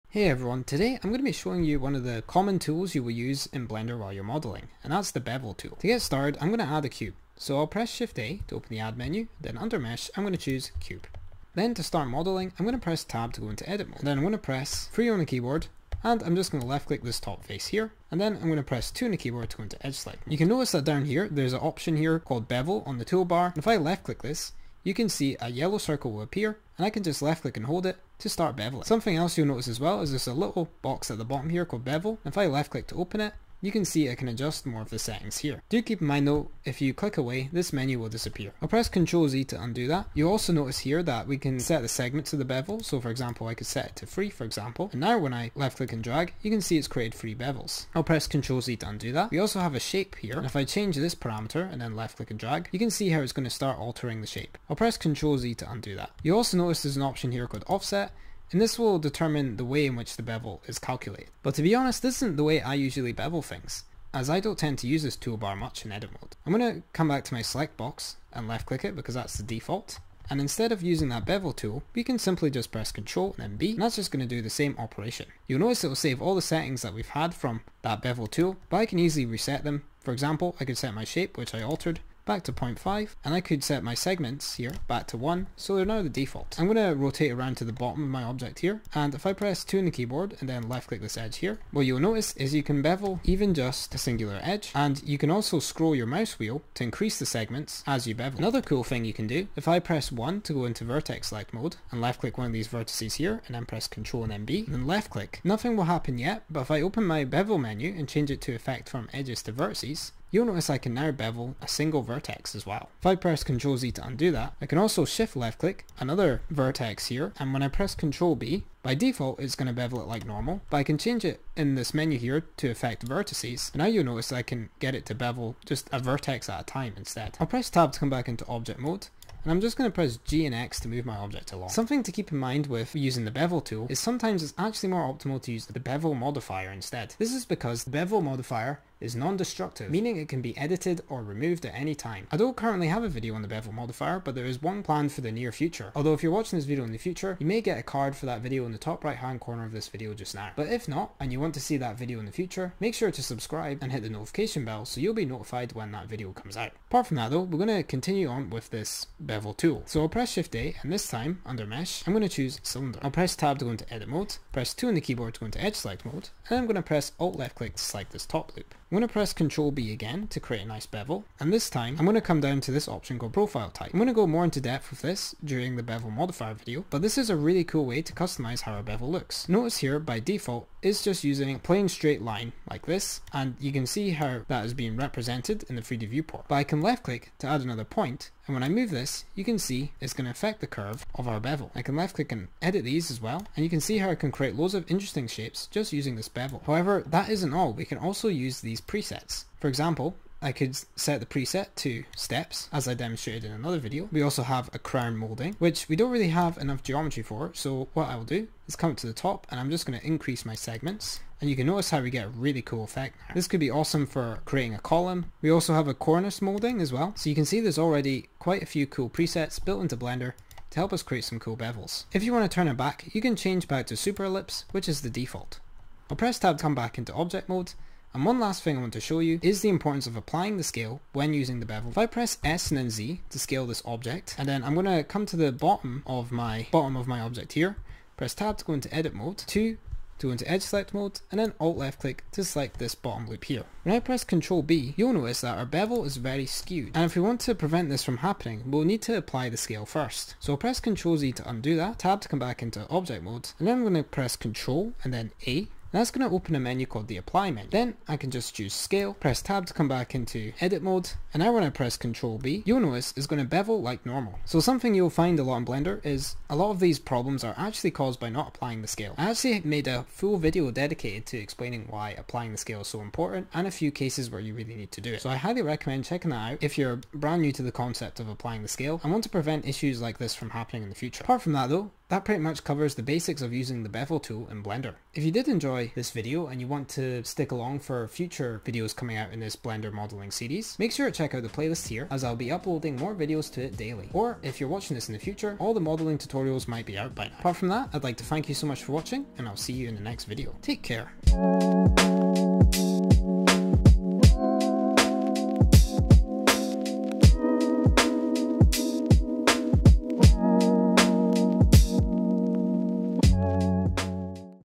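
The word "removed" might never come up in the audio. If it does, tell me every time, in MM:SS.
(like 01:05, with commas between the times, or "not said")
02:21.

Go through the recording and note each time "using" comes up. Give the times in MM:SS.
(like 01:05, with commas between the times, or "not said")
01:10, 02:12, 03:01, 03:15, 03:51, 04:43.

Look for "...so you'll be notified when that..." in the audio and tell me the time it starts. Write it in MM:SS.
02:34.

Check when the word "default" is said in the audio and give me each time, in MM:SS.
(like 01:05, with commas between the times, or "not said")
01:09, 01:26, 01:58, 03:00, 03:45.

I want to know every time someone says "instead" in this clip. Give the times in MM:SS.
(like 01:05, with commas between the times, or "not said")
01:10, 02:06, 02:16.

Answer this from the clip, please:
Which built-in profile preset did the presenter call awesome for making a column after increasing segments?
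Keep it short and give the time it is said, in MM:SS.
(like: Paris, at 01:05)
Crown molding, at 03:24.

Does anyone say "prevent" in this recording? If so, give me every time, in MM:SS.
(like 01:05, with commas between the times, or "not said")
04:07, 04:39.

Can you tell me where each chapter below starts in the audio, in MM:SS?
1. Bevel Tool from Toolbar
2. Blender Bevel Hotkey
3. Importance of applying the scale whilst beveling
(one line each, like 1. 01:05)
1. 00:20
2. 01:06
3. 03:47.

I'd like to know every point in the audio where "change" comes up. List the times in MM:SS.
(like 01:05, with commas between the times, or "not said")
00:50, 01:48, 02:00, 03:43.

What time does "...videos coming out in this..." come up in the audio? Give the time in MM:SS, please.
04:48.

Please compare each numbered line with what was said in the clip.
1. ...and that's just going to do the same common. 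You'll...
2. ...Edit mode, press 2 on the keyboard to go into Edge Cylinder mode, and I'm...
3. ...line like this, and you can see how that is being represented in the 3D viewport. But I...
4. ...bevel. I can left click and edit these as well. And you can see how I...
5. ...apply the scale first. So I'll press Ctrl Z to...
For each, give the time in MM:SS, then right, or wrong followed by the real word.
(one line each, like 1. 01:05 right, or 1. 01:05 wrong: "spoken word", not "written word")
1. 01:13 wrong: "operation", not "common"
2. 02:43 wrong: "Select", not "Cylinder"
3. 03:02 right
4. 03:11 right
5. 04:09 right.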